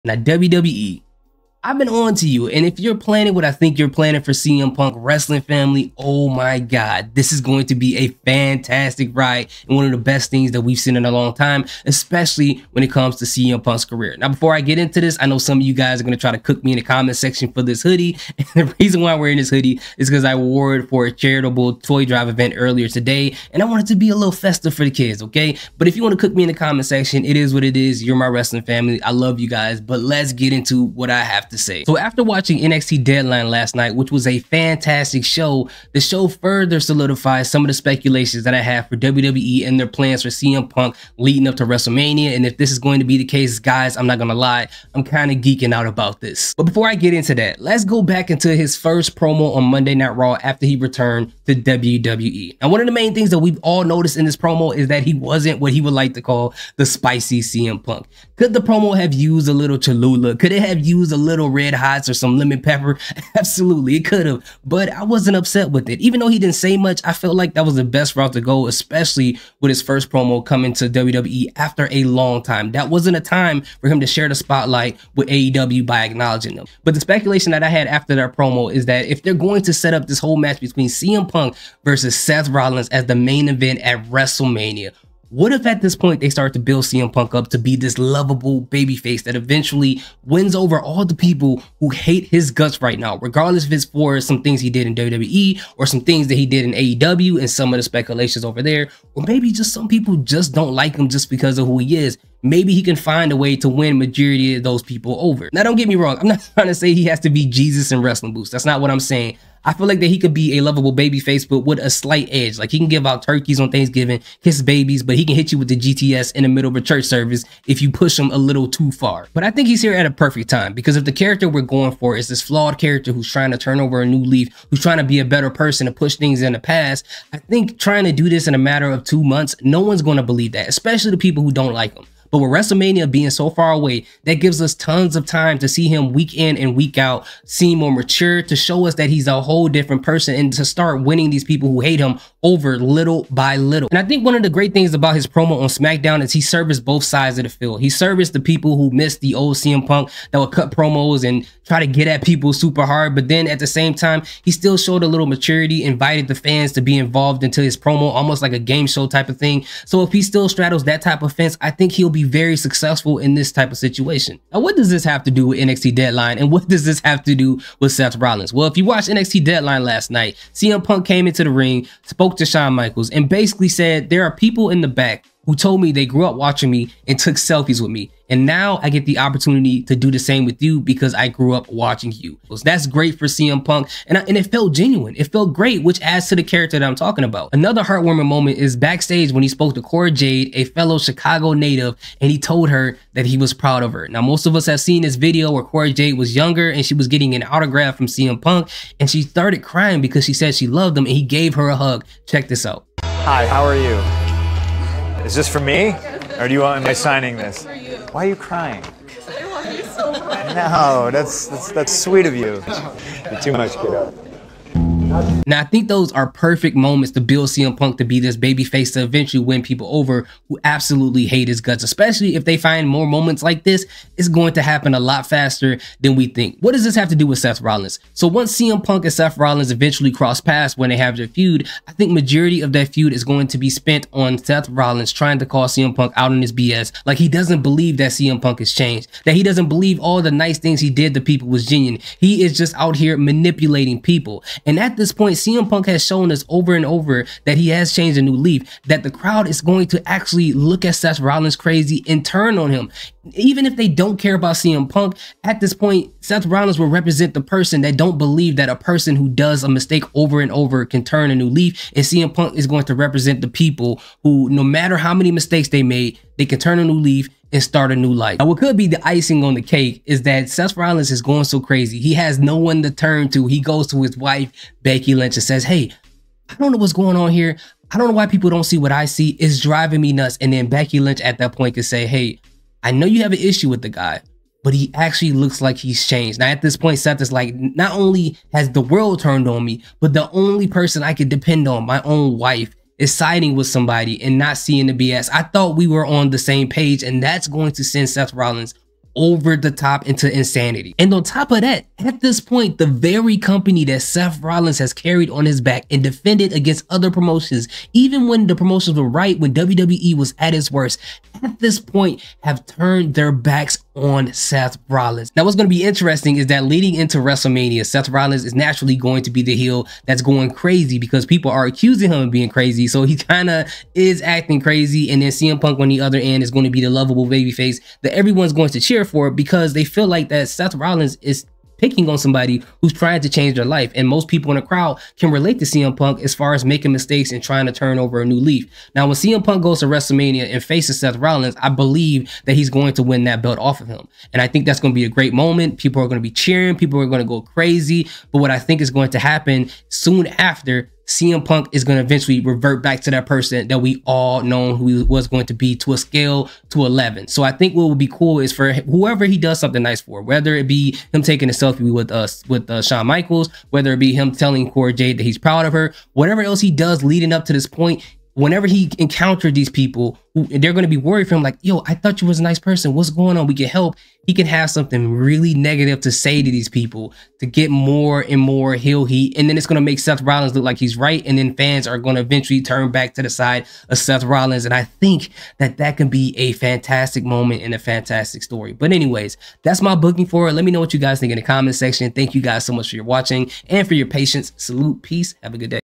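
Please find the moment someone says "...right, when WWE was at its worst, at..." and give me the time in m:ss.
5:09.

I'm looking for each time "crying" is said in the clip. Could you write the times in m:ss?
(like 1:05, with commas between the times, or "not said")
3:19, 3:28.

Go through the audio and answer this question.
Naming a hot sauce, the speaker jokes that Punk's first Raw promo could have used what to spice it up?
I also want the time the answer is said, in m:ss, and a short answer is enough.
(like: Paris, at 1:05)
Cholula, at 0:59.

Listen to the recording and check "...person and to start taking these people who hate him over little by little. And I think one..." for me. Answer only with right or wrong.
wrong.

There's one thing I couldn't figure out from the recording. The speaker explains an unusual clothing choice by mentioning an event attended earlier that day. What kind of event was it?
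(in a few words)
Charitable toy drive.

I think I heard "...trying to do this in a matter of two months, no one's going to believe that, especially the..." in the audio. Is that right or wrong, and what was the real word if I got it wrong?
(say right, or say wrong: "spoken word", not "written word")
right.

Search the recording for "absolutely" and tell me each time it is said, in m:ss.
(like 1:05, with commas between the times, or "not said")
1:03, 3:40.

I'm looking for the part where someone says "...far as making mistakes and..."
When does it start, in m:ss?
5:36.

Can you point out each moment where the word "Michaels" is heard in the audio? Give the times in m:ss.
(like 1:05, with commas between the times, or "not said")
2:52, 6:03.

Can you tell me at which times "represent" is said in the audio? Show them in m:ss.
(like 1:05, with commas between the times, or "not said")
4:16, 4:22.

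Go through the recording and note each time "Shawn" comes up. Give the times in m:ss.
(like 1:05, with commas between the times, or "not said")
2:52, 6:02.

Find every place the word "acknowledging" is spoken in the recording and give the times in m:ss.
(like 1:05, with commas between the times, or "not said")
1:16.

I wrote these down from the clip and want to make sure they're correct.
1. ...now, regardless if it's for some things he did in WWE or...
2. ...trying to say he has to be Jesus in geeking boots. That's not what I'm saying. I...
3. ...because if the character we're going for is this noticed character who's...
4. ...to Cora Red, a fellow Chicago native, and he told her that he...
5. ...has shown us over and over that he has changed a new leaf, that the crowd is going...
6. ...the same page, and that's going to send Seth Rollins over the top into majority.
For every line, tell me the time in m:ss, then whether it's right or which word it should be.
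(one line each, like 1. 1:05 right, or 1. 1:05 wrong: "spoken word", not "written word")
1. 1:32 right
2. 1:46 wrong: "wrestling", not "geeking"
3. 2:00 wrong: "flawed", not "noticed"
4. 3:09 wrong: "Jade", not "Red"
5. 4:05 right
6. 4:56 wrong: "insanity", not "majority".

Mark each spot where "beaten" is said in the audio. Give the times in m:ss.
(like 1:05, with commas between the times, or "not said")
not said.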